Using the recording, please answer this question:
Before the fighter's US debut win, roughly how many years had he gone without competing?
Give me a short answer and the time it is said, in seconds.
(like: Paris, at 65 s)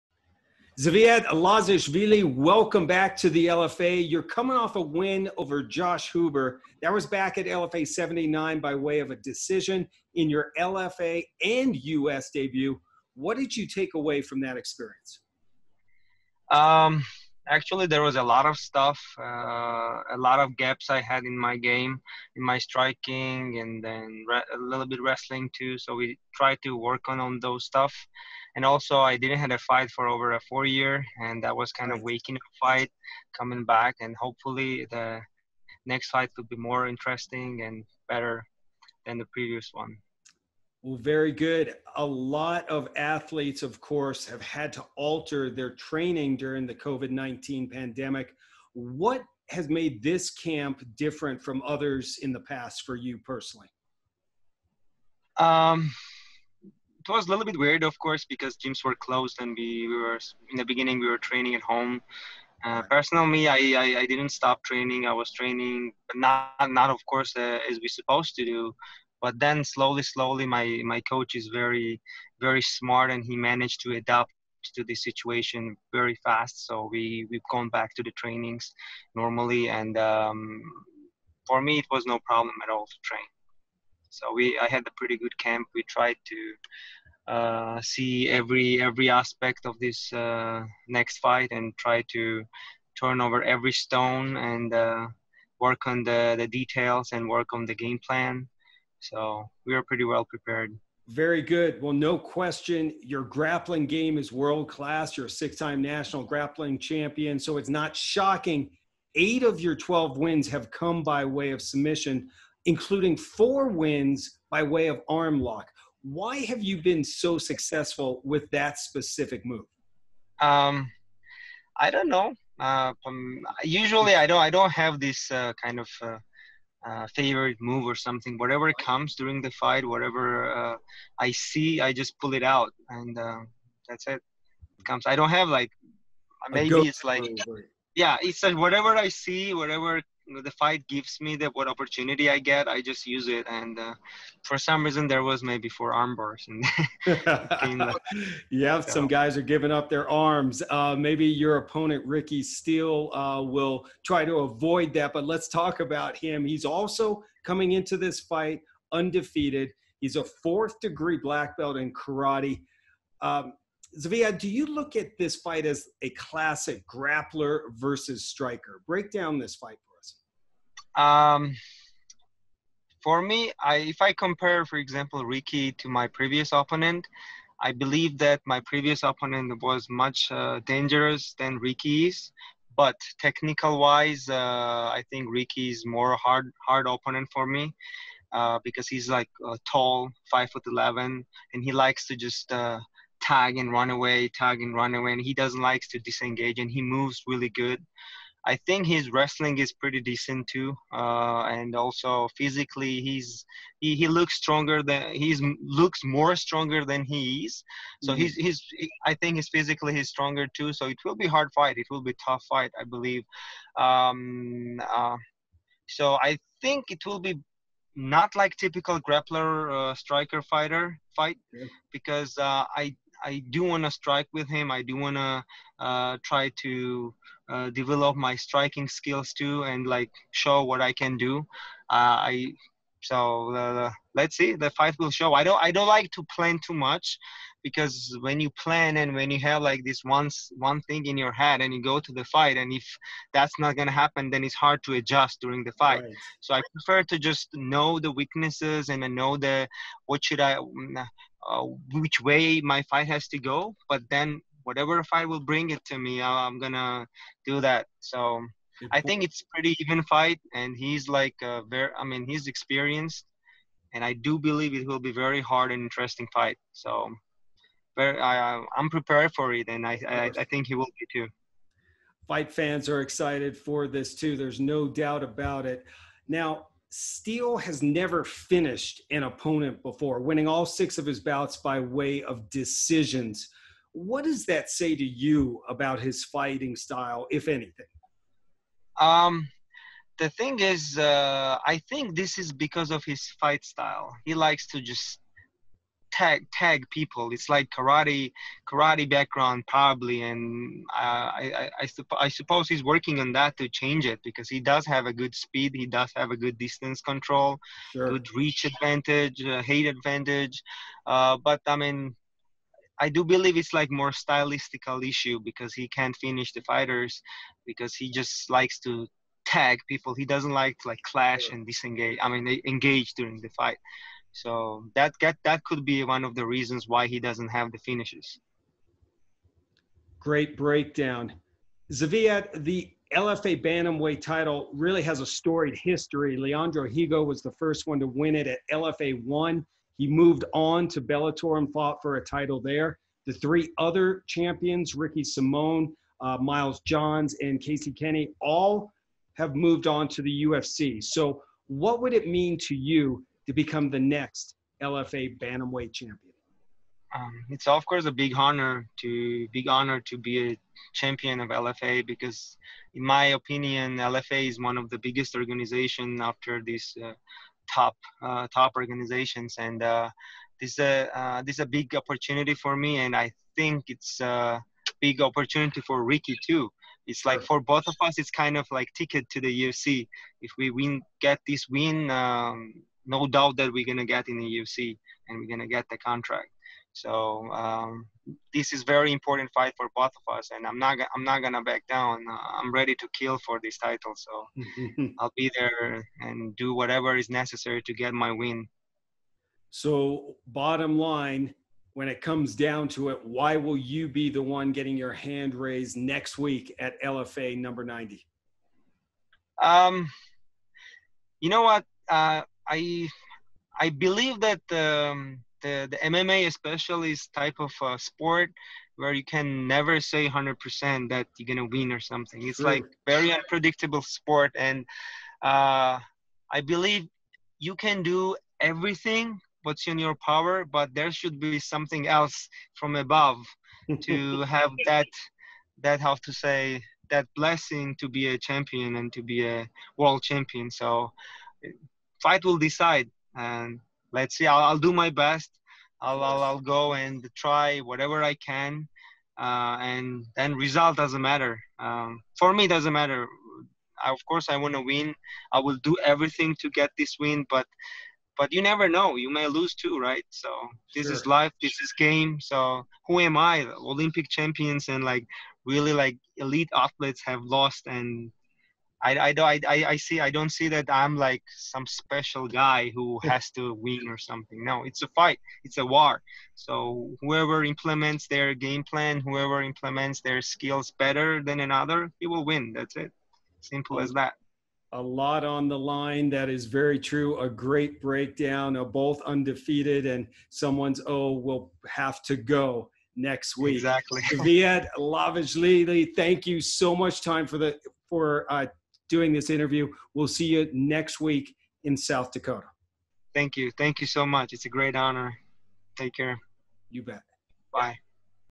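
4, at 30 s.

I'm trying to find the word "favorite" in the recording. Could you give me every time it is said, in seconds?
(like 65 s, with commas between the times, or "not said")
127 s.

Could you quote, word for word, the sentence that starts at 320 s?
He doesn't like to like clash and disengage.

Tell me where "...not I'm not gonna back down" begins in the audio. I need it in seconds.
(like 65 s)
390 s.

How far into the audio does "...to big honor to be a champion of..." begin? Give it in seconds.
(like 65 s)
359 s.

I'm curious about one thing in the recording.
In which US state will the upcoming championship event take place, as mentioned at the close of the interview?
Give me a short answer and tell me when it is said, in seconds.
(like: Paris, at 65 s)
South Dakota, at 501 s.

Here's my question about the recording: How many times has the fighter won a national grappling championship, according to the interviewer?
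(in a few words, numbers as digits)
6.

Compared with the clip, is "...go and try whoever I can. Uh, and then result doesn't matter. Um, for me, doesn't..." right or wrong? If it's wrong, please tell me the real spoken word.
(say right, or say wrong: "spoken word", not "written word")
wrong: "whatever", not "whoever".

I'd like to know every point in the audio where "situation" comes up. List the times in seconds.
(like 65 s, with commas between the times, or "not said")
75 s.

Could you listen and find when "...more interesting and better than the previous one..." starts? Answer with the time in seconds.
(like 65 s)
36 s.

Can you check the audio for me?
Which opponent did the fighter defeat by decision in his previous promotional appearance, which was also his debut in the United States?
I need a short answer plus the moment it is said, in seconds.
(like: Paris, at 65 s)
Josh Huber, at 5 s.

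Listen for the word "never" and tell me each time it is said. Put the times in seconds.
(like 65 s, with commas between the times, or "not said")
277 s, 419 s, 458 s.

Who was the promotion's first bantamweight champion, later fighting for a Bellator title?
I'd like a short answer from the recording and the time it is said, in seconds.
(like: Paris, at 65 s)
Leandro Higo, at 336 s.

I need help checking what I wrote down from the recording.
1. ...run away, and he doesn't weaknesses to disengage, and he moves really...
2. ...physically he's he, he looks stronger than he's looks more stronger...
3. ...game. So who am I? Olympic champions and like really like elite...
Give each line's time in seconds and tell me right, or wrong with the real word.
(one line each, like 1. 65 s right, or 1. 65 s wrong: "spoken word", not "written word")
1. 194 s wrong: "likes", not "weaknesses"
2. 202 s right
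3. 461 s right.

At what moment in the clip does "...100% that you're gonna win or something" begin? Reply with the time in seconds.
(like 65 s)
420 s.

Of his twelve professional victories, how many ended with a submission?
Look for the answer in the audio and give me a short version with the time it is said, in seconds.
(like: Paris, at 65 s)
8, at 109 s.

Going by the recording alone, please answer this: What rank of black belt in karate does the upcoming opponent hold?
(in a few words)
Fourth degree.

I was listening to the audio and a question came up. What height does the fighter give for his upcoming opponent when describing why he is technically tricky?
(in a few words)
5 foot 11.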